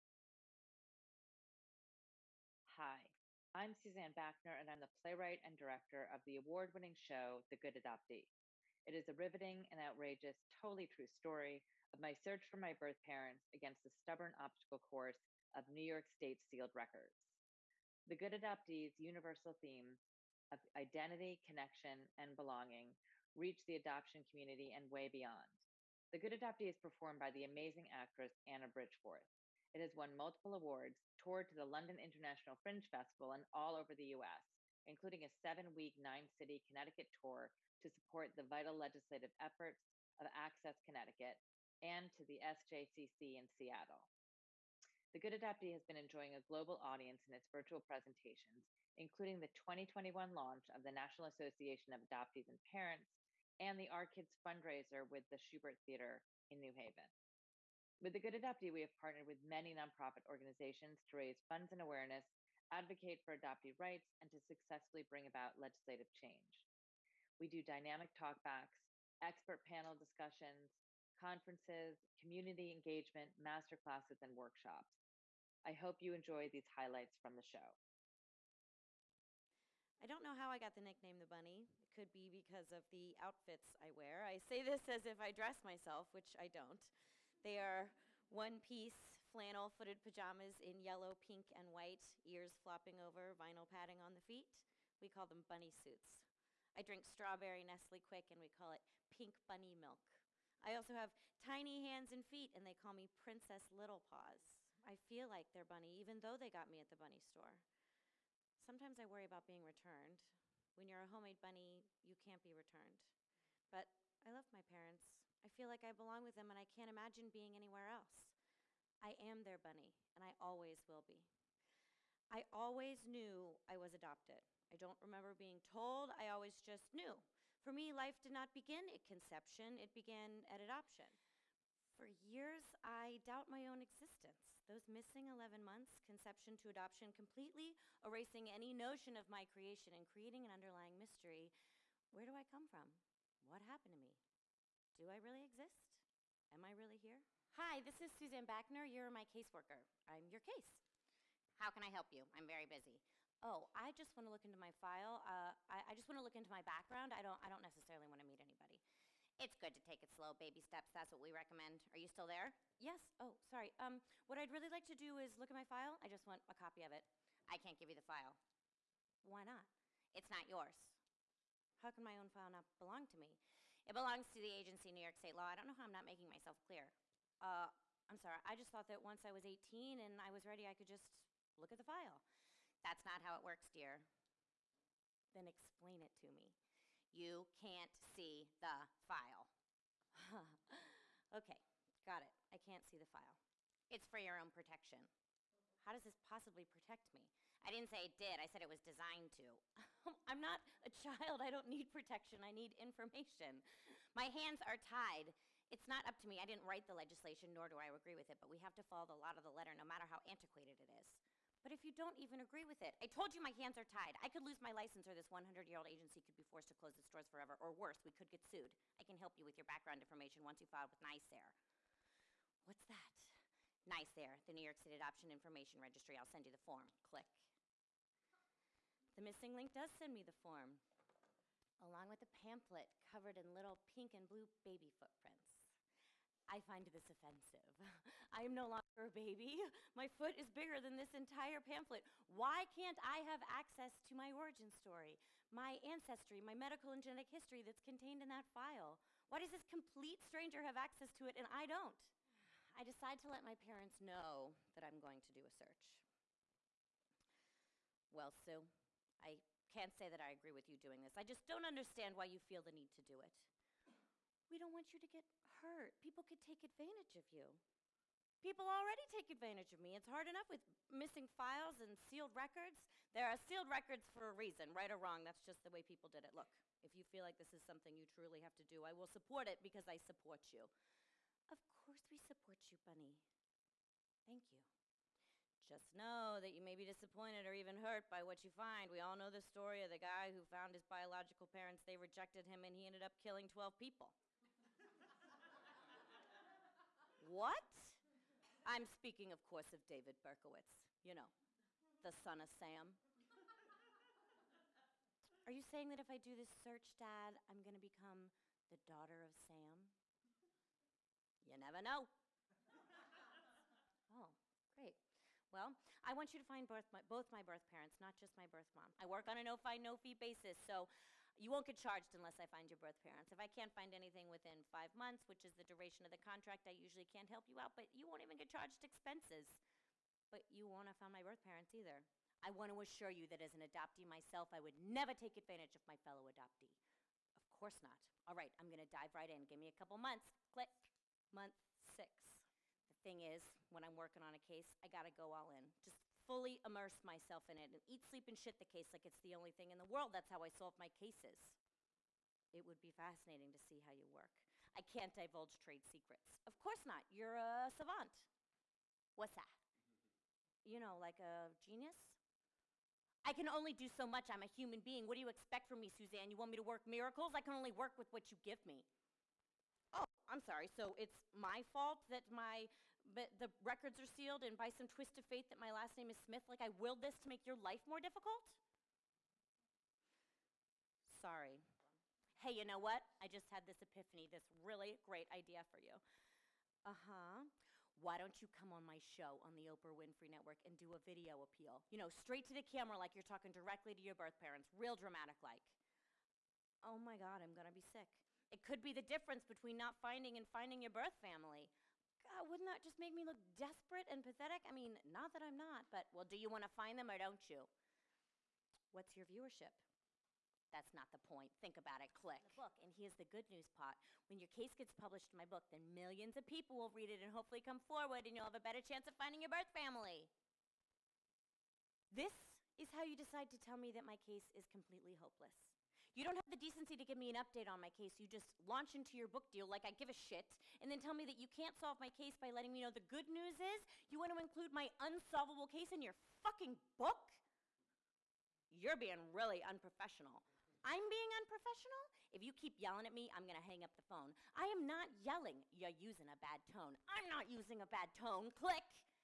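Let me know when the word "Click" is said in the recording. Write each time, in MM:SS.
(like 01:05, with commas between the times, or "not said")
03:47, 05:40, 06:52, 07:28.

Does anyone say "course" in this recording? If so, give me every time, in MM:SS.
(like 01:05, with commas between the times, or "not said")
00:14, 04:41, 04:59, 05:37, 05:56.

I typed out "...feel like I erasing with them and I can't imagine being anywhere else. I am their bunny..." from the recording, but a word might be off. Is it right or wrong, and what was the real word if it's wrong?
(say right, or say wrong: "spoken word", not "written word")
wrong: "belong", not "erasing".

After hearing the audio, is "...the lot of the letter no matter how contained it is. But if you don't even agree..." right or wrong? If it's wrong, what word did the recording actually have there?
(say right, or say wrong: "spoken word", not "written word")
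wrong: "antiquated", not "contained".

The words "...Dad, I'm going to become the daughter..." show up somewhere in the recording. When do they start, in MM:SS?
05:06.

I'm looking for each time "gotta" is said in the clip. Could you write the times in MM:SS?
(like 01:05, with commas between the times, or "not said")
05:44.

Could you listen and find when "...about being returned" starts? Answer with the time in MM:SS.
01:49.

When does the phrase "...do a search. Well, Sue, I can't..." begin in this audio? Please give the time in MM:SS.
04:15.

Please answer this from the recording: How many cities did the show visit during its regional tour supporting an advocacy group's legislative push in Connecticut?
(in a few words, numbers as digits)
9.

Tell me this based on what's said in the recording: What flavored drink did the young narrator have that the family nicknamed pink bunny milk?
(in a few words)
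strawberry Nestle Quik.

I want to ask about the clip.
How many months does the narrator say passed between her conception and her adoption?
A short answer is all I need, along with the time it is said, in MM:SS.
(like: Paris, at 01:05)
11, at 02:15.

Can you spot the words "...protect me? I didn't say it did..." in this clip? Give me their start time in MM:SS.
03:16.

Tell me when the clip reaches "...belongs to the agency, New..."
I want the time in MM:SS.
02:53.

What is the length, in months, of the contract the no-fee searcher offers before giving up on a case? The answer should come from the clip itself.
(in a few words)
5.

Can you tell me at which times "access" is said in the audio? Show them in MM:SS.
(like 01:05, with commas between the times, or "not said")
00:40, 04:03, 04:10.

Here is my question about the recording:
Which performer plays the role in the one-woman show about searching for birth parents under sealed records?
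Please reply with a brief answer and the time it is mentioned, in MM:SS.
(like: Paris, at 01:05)
Anna Bridgforth, at 00:28.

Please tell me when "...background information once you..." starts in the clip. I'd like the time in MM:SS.
03:39.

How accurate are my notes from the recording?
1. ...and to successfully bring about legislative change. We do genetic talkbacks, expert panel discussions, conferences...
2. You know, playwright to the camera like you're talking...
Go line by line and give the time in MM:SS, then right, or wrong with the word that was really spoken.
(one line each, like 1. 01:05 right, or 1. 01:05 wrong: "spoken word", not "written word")
1. 01:04 wrong: "dynamic", not "genetic"
2. 06:31 wrong: "straight", not "playwright".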